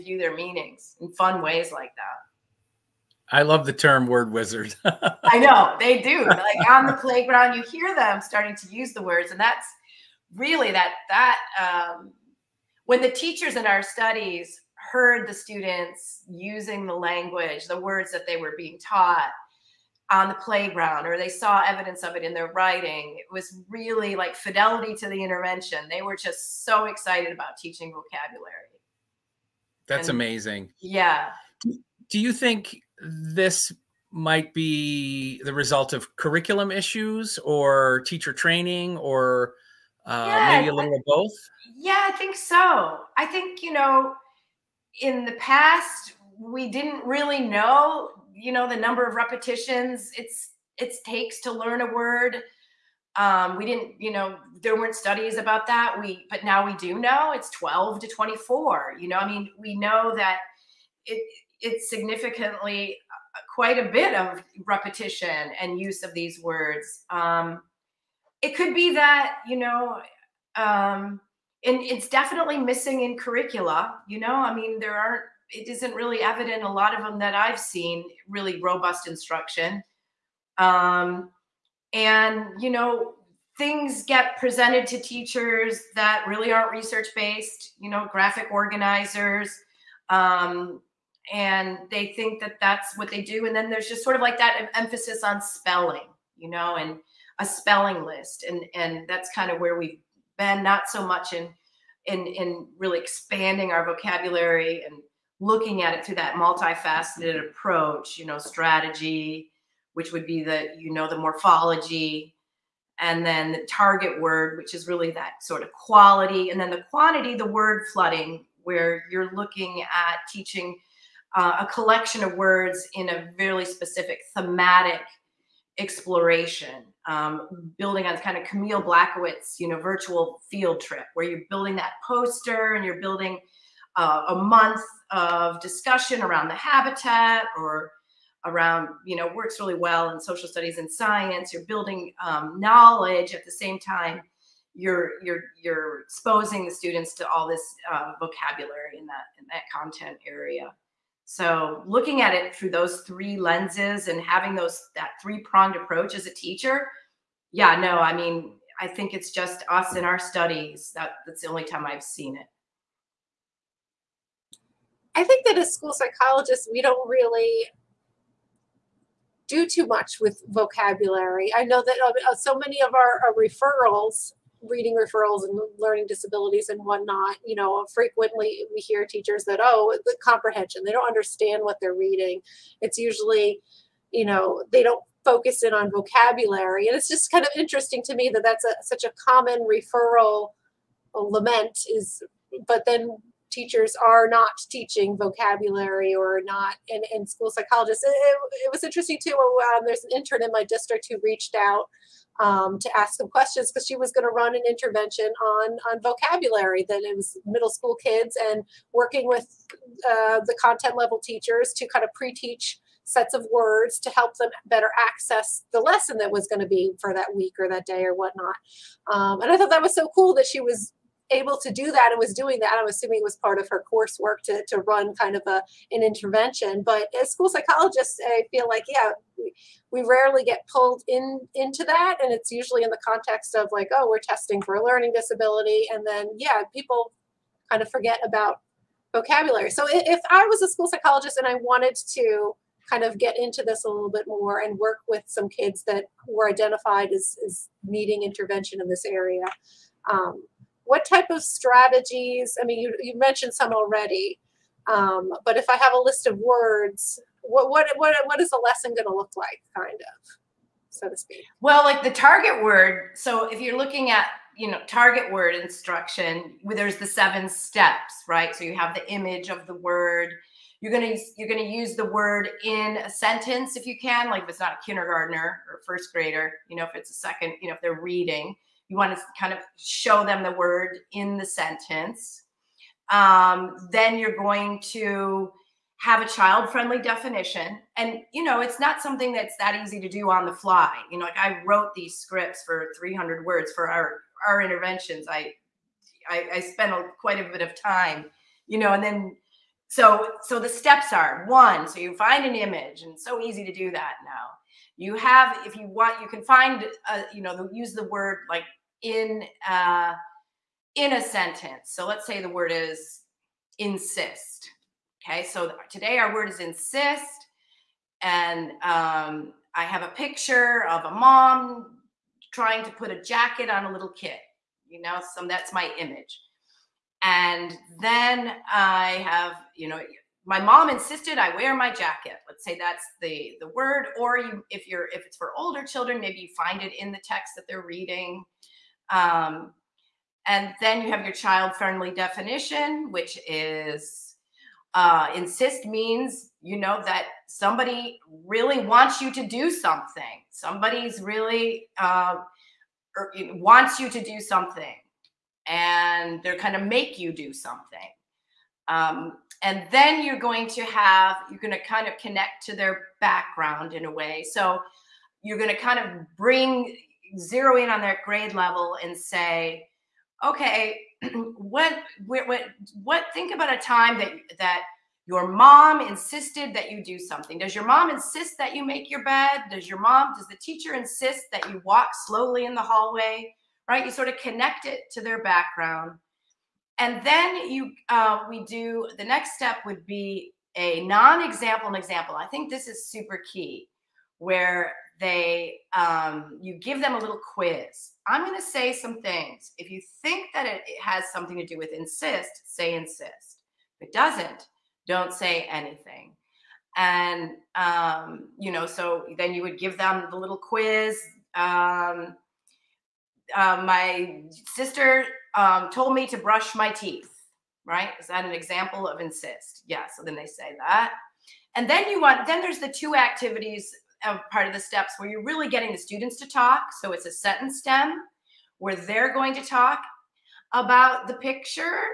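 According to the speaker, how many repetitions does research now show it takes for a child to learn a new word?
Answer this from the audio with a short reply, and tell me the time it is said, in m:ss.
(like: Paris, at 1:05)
12 to 24, at 0:57.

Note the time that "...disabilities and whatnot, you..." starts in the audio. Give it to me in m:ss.
2:56.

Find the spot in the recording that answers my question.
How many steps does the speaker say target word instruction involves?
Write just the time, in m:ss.
4:27.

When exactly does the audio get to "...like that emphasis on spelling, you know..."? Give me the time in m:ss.
1:34.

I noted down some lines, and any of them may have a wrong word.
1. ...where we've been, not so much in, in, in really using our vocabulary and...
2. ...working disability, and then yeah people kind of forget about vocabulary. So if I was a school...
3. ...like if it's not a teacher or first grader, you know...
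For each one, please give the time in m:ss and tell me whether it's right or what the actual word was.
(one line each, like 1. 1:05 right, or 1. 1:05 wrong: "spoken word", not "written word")
1. 1:39 wrong: "expanding", not "using"
2. 3:54 wrong: "learning", not "working"
3. 4:34 wrong: "kindergartner", not "teacher".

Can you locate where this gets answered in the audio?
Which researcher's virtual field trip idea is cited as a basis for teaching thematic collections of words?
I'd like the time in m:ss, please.
2:08.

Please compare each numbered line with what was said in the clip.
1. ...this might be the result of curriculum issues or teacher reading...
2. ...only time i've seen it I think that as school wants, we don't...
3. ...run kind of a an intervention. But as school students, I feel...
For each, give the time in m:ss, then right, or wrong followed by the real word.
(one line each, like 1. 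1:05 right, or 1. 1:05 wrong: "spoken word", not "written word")
1. 0:33 wrong: "training", not "reading"
2. 2:41 wrong: "psychologists", not "wants"
3. 3:44 wrong: "psychologists", not "students".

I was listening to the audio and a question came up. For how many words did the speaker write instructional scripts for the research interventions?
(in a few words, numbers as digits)
300.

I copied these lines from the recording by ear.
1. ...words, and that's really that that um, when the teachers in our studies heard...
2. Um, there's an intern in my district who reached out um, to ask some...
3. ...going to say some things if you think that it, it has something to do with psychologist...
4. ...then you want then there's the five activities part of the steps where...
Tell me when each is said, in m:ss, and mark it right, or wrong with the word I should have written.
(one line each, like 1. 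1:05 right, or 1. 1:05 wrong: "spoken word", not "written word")
1. 0:09 right
2. 3:19 right
3. 6:38 wrong: "insist", not "psychologist"
4. 7:01 wrong: "two", not "five".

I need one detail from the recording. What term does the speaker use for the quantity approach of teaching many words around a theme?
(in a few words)
word flooding.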